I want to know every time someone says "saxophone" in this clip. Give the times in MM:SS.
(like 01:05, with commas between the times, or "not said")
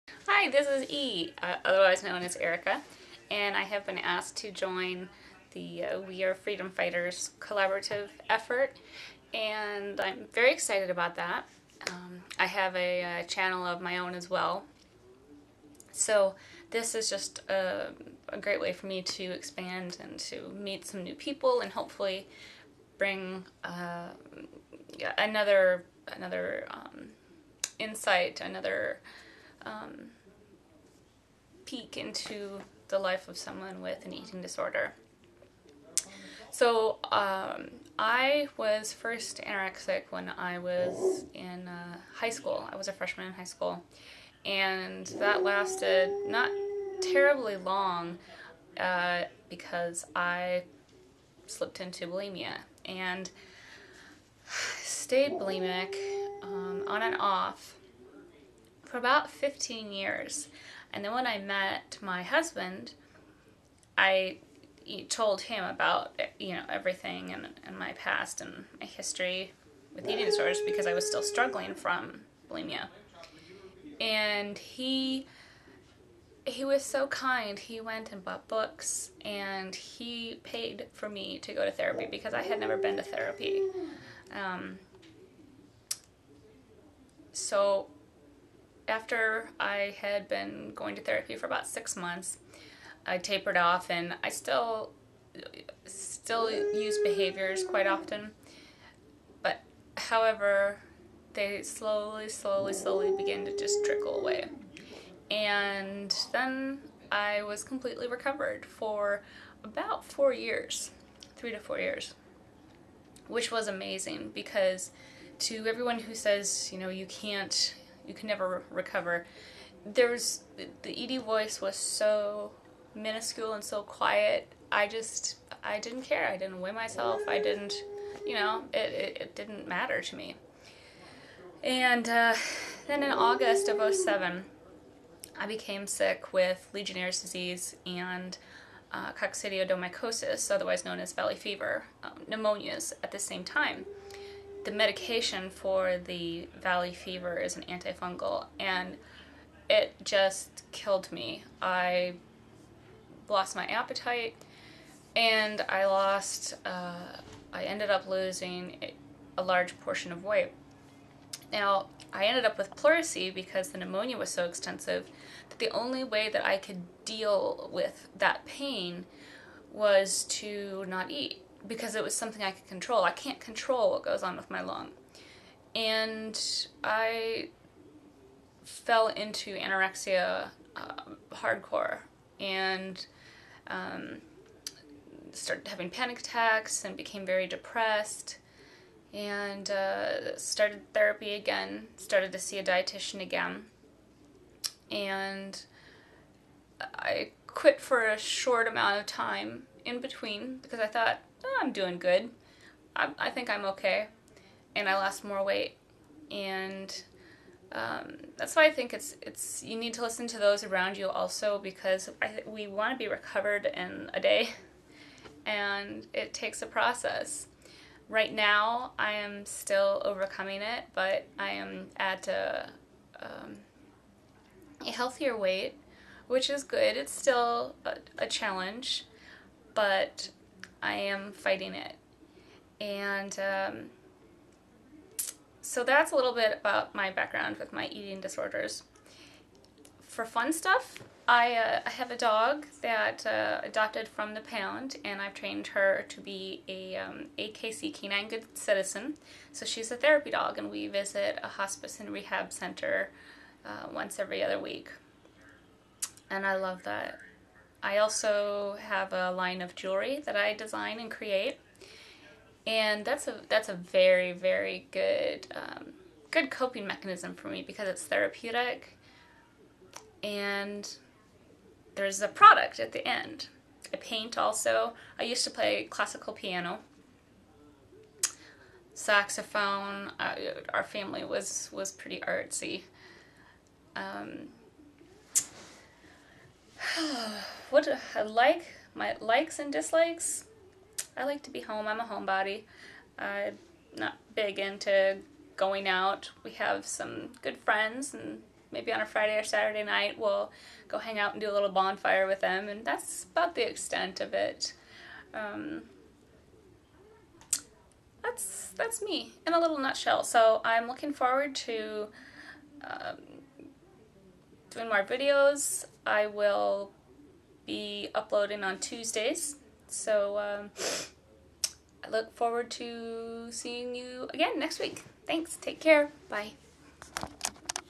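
04:38.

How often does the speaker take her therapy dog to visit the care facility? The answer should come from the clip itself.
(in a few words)
Every other week.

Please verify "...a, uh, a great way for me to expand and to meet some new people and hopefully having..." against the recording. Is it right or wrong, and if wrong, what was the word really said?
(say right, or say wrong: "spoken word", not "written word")
wrong: "bring", not "having".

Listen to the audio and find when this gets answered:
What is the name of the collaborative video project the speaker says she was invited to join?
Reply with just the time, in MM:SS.
00:06.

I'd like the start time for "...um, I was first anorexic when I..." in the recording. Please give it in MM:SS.
00:37.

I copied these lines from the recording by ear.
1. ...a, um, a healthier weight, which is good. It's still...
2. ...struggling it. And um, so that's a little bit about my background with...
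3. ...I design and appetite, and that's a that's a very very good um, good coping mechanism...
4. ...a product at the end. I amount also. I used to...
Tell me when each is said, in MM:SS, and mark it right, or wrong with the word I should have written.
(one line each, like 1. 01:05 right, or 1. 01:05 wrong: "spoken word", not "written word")
1. 03:42 right
2. 03:51 wrong: "fighting", not "struggling"
3. 04:20 wrong: "create", not "appetite"
4. 04:32 wrong: "paint", not "amount".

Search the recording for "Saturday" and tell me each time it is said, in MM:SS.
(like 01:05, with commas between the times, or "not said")
04:59.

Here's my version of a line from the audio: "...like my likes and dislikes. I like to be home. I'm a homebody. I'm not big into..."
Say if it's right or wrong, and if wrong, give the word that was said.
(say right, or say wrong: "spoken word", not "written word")
right.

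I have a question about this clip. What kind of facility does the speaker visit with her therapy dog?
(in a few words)
Hospice and rehab center.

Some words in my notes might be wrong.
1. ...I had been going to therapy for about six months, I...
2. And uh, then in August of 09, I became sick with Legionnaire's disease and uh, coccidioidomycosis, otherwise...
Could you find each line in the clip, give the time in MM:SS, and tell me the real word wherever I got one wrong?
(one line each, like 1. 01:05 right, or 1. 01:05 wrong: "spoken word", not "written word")
1. 01:29 right
2. 02:11 wrong: "07", not "09".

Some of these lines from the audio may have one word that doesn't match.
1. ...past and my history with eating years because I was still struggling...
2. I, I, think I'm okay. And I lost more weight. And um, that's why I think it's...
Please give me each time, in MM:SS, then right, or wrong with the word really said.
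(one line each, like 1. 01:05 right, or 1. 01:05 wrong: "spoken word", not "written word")
1. 01:07 wrong: "disorders", not "years"
2. 03:22 right.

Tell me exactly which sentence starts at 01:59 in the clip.
There's the Ed voice was so minuscule and so quiet.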